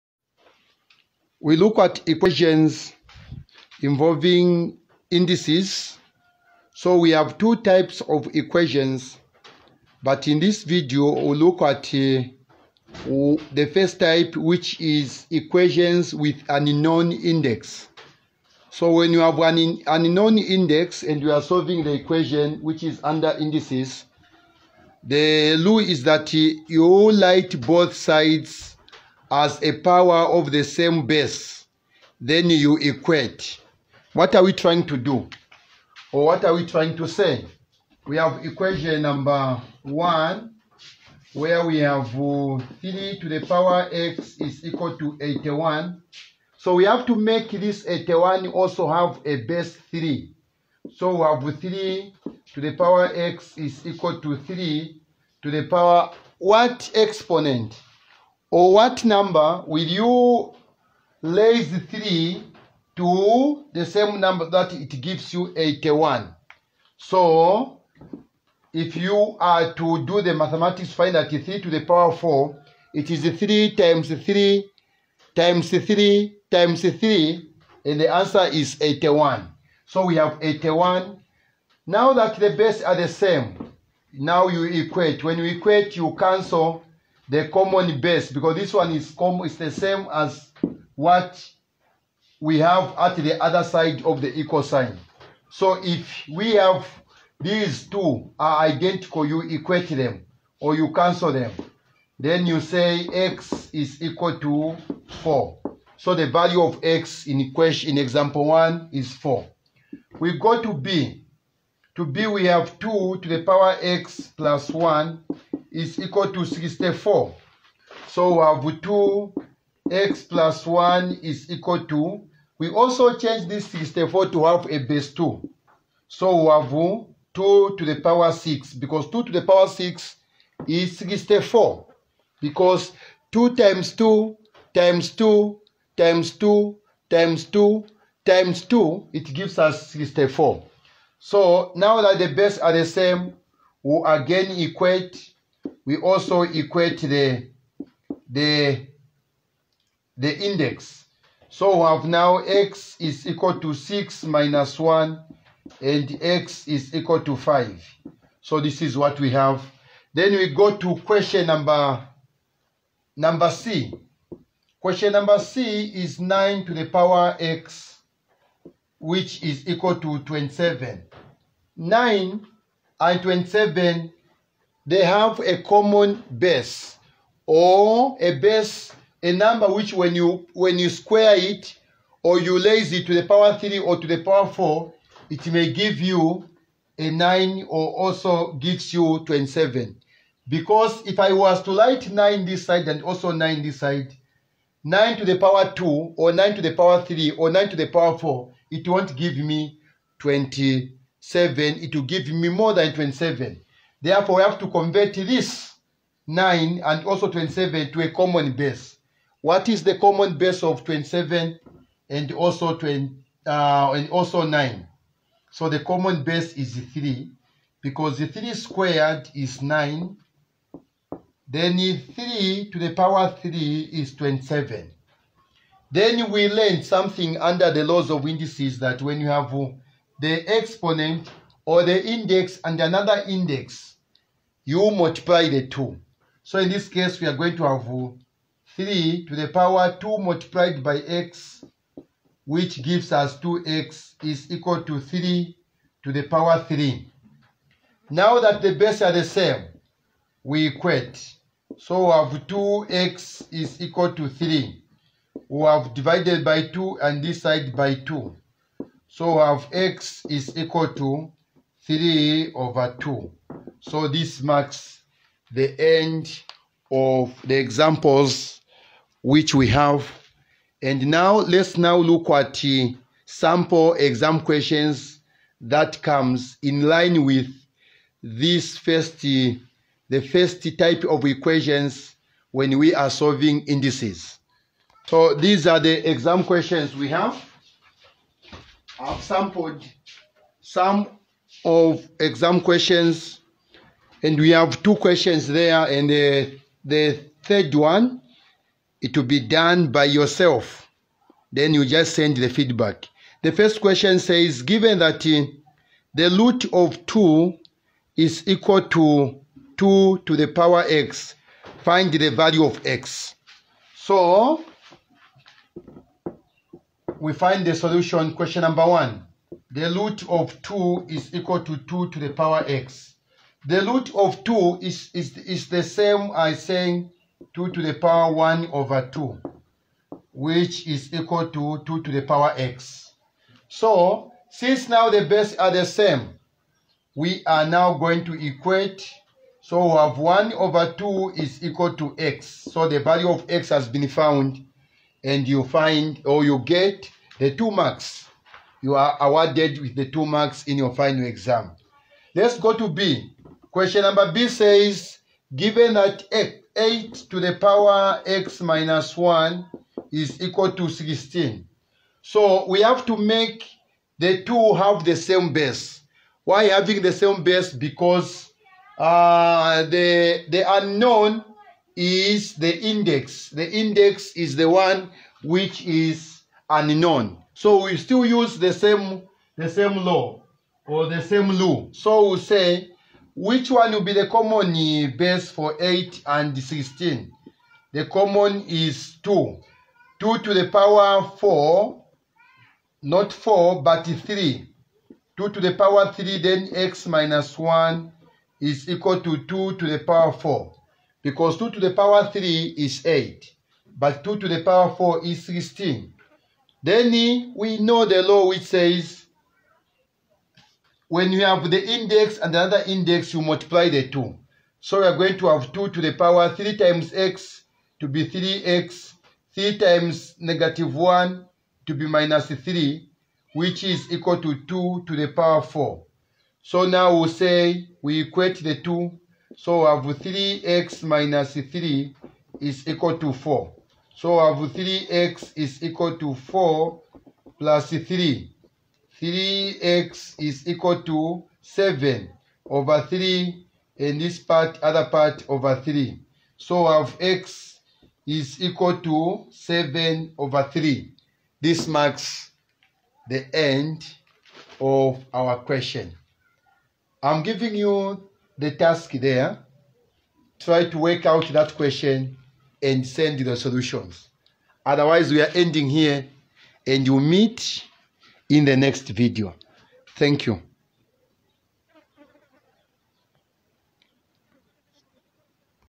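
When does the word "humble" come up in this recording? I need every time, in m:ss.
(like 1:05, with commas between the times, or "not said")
not said.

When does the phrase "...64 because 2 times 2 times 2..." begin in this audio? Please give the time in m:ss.
2:10.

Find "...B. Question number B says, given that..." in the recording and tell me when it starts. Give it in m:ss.
5:52.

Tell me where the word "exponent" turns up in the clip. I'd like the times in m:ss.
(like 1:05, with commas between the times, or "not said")
0:56, 3:50.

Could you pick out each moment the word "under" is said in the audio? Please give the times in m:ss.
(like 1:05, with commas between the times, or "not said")
0:23, 3:47.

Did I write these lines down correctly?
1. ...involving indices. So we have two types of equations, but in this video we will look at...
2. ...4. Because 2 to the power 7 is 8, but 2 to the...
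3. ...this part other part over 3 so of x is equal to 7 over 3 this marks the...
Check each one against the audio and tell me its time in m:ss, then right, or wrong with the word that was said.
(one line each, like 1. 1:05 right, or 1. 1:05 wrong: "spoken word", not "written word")
1. 0:03 right
2. 6:40 wrong: "3", not "7"
3. 7:24 right.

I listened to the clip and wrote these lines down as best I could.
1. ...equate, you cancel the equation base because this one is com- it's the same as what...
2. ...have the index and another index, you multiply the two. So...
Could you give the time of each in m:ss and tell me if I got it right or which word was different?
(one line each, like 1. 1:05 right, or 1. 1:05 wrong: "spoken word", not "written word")
1. 1:25 wrong: "common", not "equation"
2. 6:51 right.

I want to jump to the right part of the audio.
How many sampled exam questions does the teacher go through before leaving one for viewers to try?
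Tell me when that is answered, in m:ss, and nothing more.
4:54.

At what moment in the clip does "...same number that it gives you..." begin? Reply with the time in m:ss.
1:03.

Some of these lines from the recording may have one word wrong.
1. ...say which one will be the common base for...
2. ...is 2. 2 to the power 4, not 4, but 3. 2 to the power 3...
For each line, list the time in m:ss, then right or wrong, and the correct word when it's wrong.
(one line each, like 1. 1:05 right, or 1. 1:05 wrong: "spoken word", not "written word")
1. 6:22 right
2. 6:28 right.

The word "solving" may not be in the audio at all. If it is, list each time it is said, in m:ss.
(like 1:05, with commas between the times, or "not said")
0:21, 4:43.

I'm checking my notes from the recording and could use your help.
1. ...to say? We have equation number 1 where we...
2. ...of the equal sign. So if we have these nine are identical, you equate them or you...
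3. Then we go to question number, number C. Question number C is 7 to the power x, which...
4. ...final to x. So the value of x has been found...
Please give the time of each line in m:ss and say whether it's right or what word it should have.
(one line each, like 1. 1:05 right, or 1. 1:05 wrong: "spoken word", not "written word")
1. 0:36 right
2. 1:34 wrong: "two", not "nine"
3. 2:40 wrong: "9", not "7"
4. 5:41 wrong: "equal", not "final".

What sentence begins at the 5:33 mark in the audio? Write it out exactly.
So, since now the base are the same, we are now going to equate.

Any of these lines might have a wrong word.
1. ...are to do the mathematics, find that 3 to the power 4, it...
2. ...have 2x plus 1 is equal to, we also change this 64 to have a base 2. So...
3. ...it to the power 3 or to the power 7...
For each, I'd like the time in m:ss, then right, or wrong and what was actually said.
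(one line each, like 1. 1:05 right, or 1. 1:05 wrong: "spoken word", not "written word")
1. 1:09 right
2. 1:58 right
3. 3:02 wrong: "4", not "7".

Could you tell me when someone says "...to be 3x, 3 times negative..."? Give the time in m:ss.
6:57.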